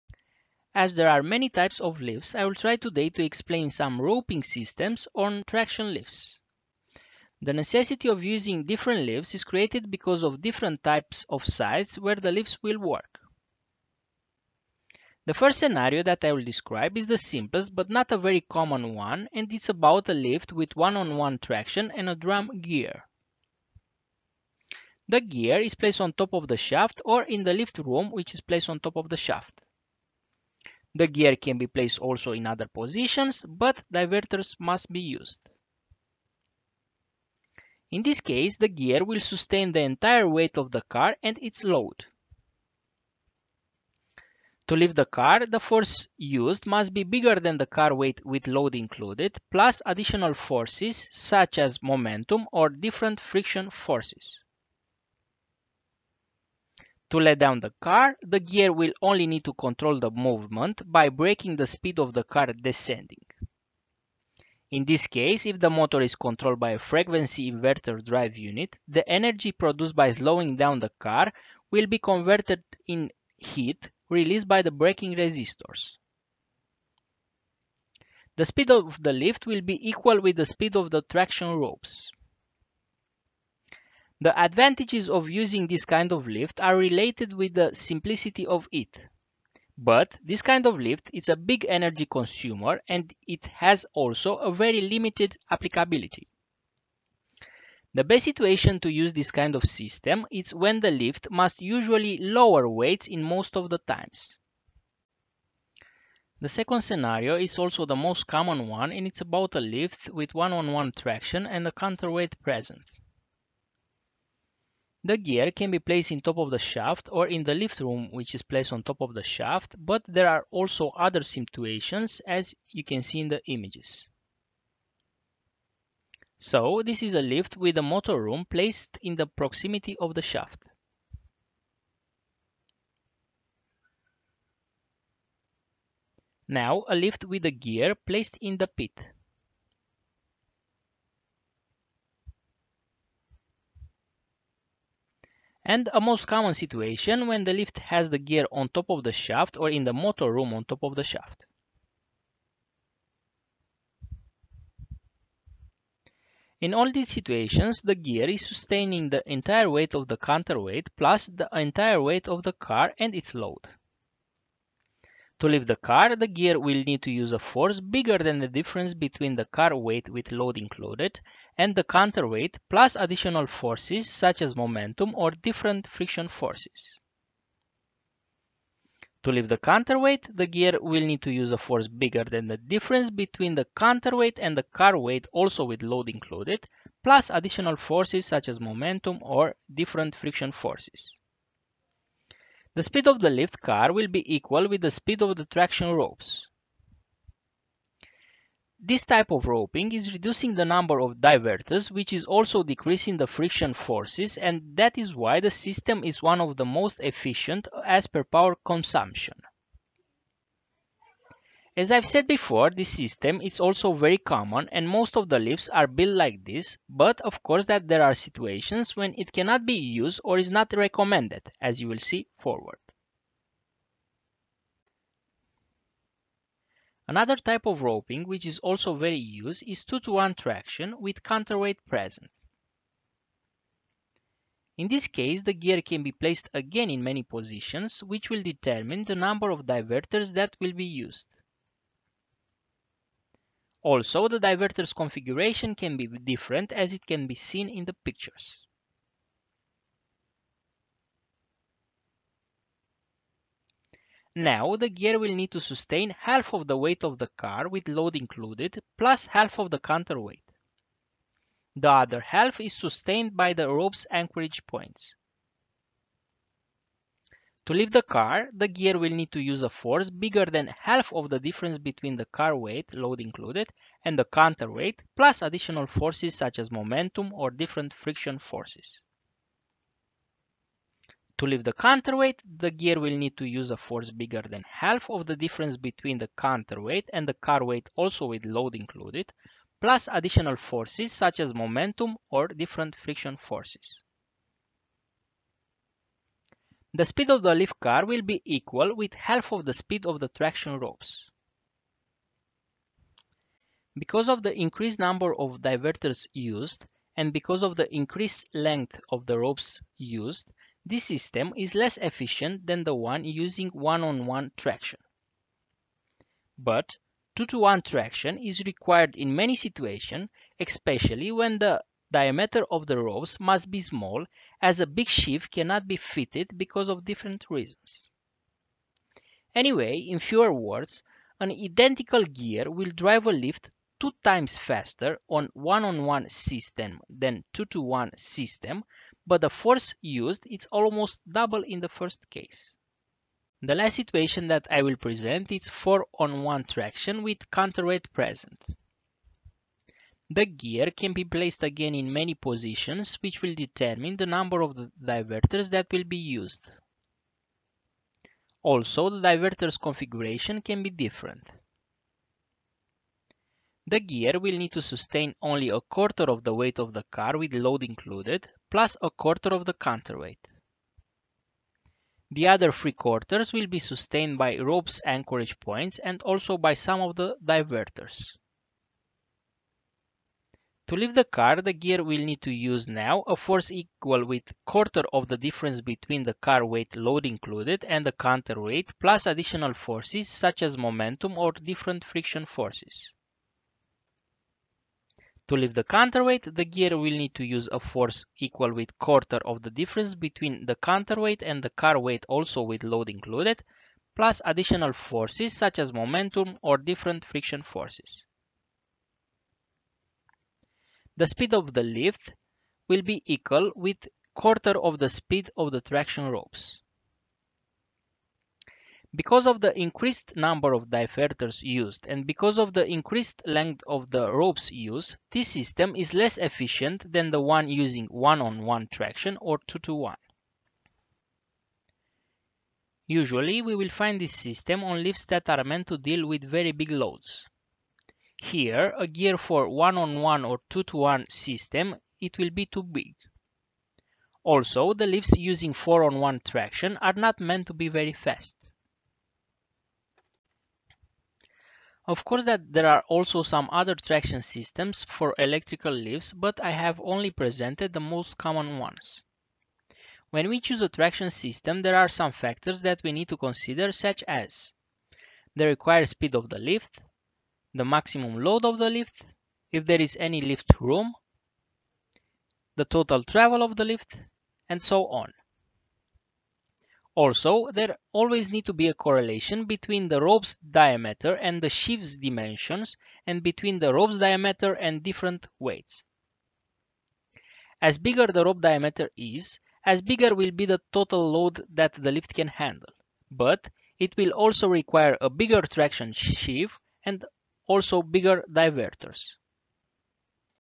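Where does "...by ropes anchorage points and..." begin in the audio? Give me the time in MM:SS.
06:14.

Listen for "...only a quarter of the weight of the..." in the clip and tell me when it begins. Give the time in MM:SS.
06:05.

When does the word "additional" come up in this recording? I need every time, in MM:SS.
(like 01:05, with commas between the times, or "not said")
00:49, 02:52, 03:07, 04:35, 04:50, 06:29, 06:44.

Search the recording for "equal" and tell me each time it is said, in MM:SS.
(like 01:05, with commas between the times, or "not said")
01:19, 03:14, 04:58, 06:23, 06:38, 06:53.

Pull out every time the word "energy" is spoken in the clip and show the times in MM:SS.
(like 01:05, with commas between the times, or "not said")
01:09, 01:31.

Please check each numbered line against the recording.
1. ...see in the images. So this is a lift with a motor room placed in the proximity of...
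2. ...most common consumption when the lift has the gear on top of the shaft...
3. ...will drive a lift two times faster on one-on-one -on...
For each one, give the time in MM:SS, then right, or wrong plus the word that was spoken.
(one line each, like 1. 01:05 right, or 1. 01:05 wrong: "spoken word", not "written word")
1. 02:03 right
2. 02:26 wrong: "situation", not "consumption"
3. 05:32 right.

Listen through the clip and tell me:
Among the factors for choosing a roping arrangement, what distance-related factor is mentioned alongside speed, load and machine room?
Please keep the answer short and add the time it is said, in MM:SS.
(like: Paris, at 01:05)
total travel, at 07:52.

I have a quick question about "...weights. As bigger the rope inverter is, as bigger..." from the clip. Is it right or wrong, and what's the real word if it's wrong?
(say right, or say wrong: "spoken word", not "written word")
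wrong: "diameter", not "inverter".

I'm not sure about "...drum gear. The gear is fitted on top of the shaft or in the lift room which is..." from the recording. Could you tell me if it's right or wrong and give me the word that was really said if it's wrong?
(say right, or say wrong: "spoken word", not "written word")
wrong: "placed", not "fitted".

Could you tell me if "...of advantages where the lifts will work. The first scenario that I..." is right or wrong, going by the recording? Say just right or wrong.
wrong.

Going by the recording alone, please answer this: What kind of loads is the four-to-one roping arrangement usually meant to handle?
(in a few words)
very big loads.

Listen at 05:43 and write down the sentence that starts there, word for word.
The last situation that I will present is 4 on 1 traction with counterweight present.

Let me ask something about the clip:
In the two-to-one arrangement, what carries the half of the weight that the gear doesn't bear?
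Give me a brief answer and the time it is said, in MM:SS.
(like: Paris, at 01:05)
rope's anchorage points, at 04:23.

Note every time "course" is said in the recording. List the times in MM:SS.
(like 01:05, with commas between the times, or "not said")
03:37, 07:32.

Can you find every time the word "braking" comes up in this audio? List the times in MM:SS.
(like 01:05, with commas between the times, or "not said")
01:01, 01:14.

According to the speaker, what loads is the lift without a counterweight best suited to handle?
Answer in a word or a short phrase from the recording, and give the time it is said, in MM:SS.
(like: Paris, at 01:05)
lower weights, at 01:42.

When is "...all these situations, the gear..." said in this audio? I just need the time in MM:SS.
02:36.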